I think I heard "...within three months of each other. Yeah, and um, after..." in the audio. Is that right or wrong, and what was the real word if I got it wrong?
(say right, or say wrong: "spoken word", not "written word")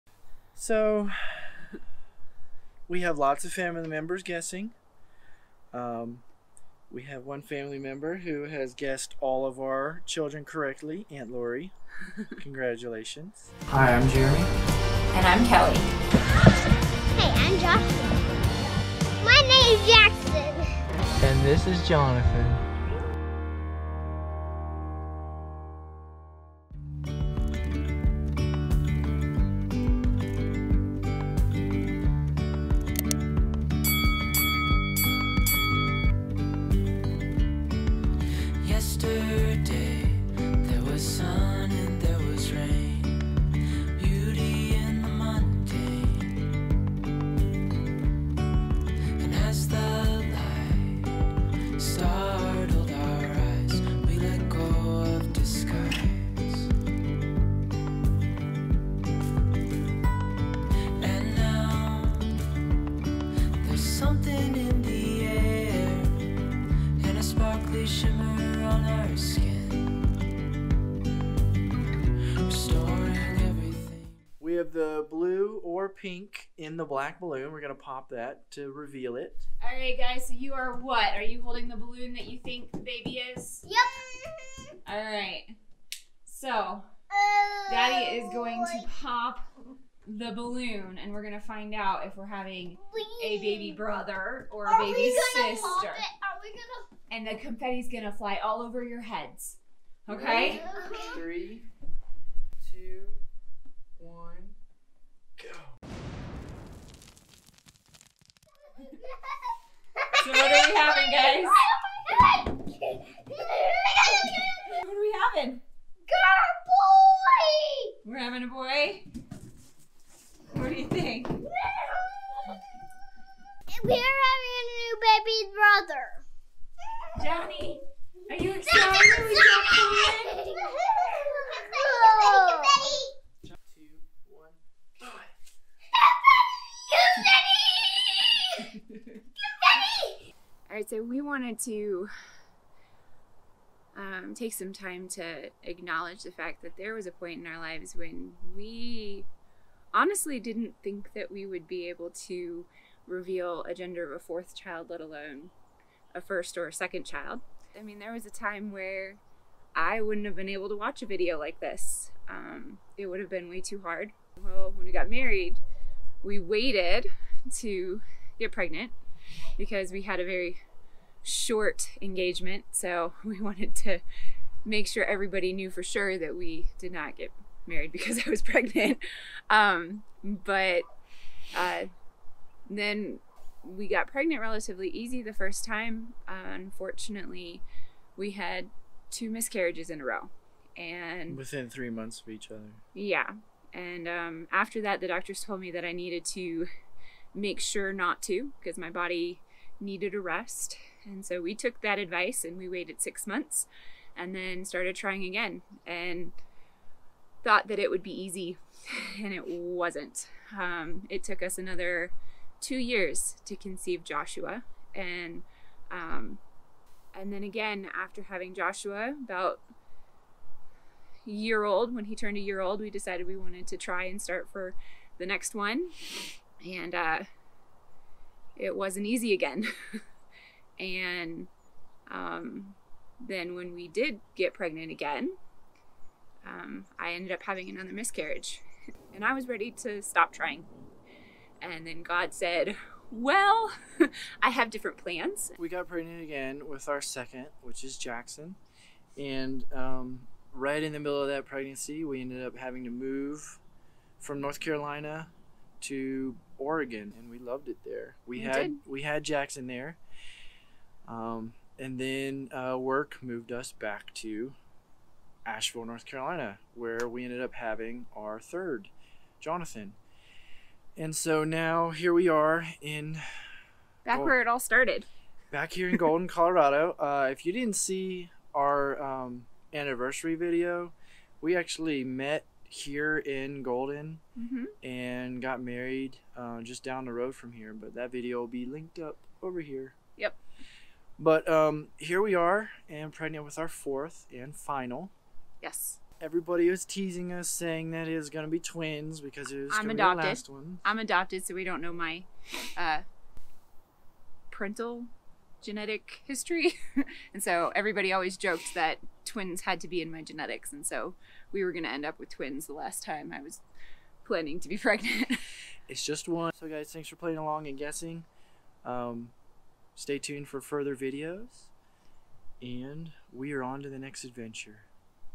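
right.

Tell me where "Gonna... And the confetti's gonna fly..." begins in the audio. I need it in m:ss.
1:35.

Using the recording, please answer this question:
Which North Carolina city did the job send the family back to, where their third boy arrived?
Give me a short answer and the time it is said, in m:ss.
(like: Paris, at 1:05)
Asheville, at 4:25.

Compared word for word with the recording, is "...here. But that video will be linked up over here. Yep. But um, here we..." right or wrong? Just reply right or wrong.
right.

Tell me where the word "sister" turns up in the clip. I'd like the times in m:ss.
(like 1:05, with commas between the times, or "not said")
1:35.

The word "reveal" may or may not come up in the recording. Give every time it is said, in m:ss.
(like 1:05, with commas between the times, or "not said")
1:18, 2:33.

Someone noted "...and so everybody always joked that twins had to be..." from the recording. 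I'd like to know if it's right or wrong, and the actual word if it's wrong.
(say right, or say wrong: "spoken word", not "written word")
right.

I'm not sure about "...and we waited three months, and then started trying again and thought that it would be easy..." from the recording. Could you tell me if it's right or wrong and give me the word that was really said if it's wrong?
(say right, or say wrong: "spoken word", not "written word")
wrong: "six", not "three".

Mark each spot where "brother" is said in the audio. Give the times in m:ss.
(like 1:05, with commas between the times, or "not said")
1:33, 2:05.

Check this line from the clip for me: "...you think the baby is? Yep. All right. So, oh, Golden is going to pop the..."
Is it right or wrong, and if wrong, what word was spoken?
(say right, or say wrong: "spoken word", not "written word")
wrong: "Daddy", not "Golden".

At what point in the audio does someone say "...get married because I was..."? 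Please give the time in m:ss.
2:57.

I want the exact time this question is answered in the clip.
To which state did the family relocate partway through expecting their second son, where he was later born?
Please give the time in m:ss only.
4:16.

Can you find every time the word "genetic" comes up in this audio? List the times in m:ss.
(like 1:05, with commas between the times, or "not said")
5:05, 5:10.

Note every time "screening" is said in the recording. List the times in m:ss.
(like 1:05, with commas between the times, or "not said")
not said.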